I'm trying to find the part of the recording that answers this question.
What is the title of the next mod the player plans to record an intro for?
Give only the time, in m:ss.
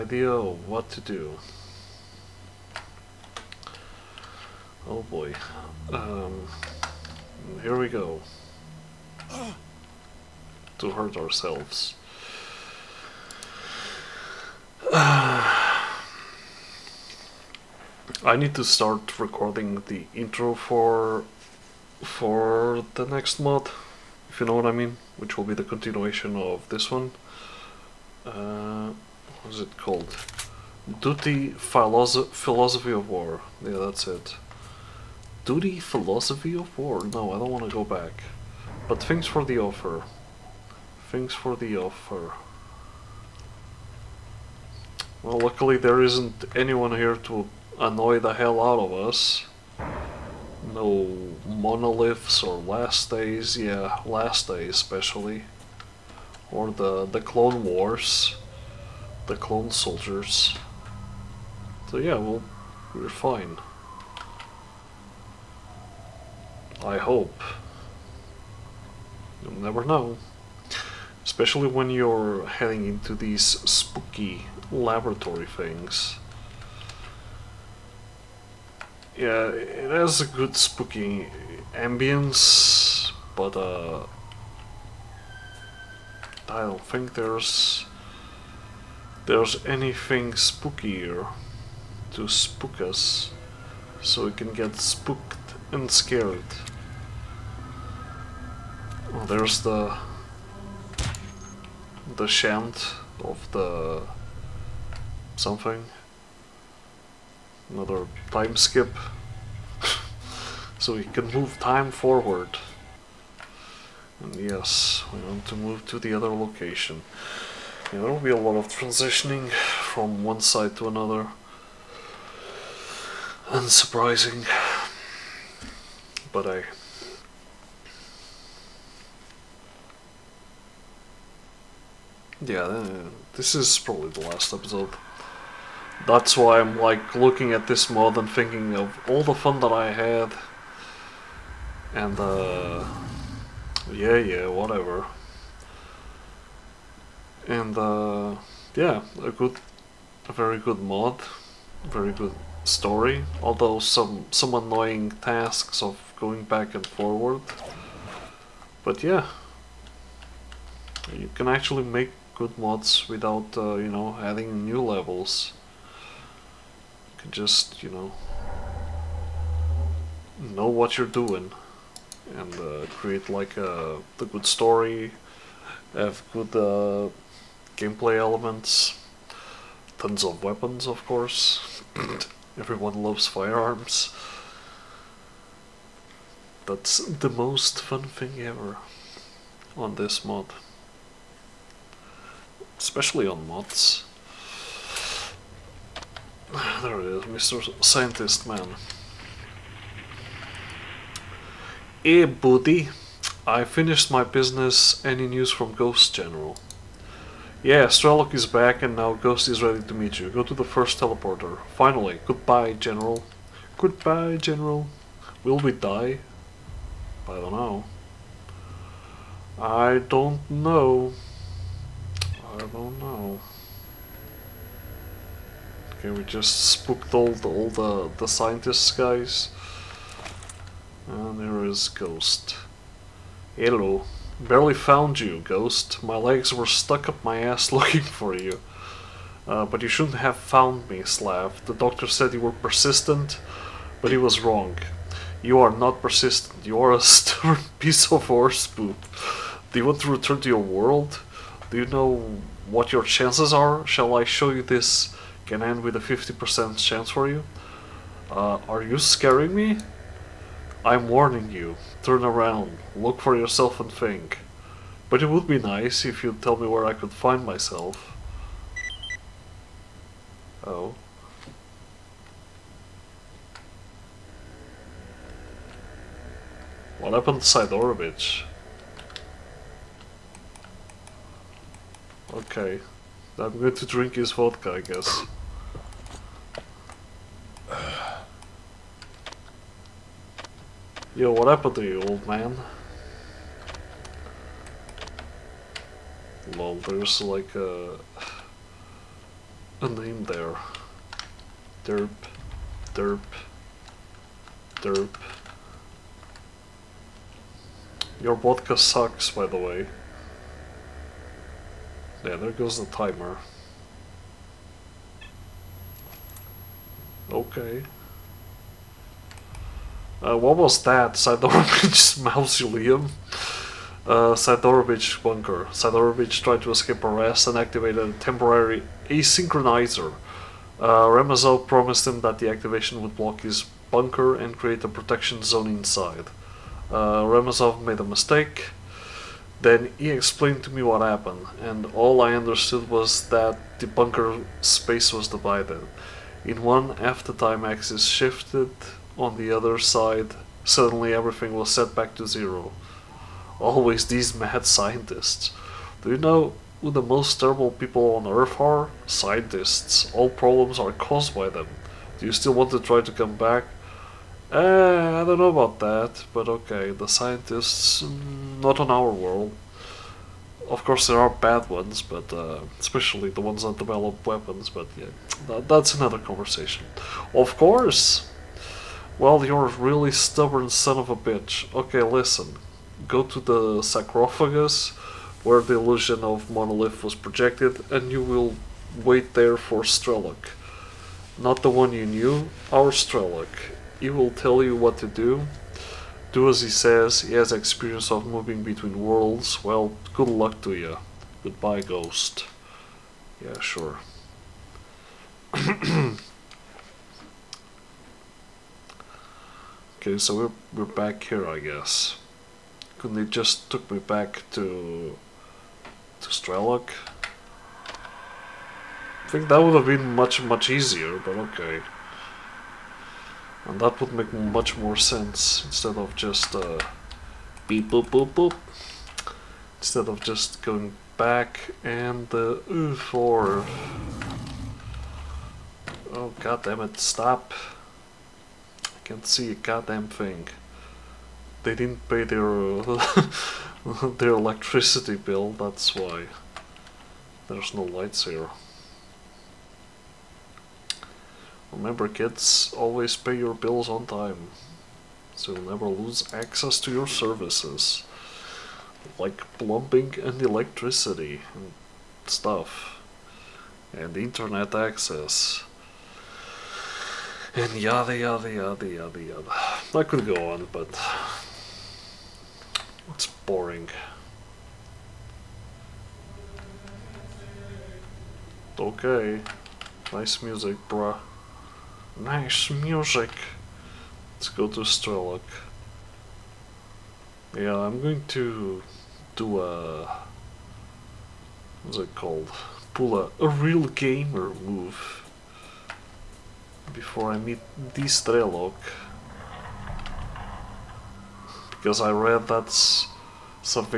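0:31.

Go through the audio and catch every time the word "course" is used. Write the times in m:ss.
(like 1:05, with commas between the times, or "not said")
3:01, 6:10, 6:17.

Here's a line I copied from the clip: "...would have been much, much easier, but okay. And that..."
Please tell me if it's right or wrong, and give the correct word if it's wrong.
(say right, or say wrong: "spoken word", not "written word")
right.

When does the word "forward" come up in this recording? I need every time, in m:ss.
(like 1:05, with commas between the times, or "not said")
1:51, 2:36, 7:12.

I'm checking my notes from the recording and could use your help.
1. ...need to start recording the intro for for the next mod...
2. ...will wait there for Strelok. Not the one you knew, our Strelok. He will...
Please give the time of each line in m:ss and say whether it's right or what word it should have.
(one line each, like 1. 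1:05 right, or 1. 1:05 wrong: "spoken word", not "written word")
1. 0:18 right
2. 6:28 right.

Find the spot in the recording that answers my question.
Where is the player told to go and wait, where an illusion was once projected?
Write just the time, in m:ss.
6:23.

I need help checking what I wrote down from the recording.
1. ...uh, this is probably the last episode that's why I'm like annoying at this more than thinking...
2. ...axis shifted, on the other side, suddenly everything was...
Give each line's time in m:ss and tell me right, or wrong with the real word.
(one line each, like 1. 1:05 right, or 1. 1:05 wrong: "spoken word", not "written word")
1. 2:12 wrong: "looking", not "annoying"
2. 5:47 right.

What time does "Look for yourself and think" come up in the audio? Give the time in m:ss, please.
4:22.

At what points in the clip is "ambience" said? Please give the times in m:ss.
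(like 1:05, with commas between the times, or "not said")
1:21.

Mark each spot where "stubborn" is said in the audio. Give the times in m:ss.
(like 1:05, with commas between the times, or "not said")
4:06, 6:20.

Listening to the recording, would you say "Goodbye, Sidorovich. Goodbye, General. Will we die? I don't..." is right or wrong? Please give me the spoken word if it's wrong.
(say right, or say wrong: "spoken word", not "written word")
wrong: "General", not "Sidorovich".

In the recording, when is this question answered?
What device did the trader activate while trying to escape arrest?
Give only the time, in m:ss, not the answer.
5:28.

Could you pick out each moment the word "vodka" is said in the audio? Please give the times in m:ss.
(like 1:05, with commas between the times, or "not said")
4:44, 5:08.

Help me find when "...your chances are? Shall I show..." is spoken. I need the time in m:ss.
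4:12.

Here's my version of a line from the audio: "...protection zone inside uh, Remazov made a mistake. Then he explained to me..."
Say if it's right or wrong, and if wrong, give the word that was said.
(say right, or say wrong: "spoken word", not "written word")
right.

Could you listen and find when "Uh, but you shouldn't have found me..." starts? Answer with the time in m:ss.
3:59.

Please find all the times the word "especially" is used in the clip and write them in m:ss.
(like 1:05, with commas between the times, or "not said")
0:54, 1:11, 3:12, 6:12.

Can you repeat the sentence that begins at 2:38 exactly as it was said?
But yeah, you can actually make good mods without, uh, you know, adding new levels.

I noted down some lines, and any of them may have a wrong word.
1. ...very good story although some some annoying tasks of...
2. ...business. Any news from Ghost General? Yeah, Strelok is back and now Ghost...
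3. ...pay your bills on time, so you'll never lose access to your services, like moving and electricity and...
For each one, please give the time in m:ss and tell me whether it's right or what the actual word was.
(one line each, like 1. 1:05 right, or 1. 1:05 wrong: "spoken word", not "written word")
1. 2:31 right
2. 3:24 right
3. 7:33 wrong: "plumbing", not "moving".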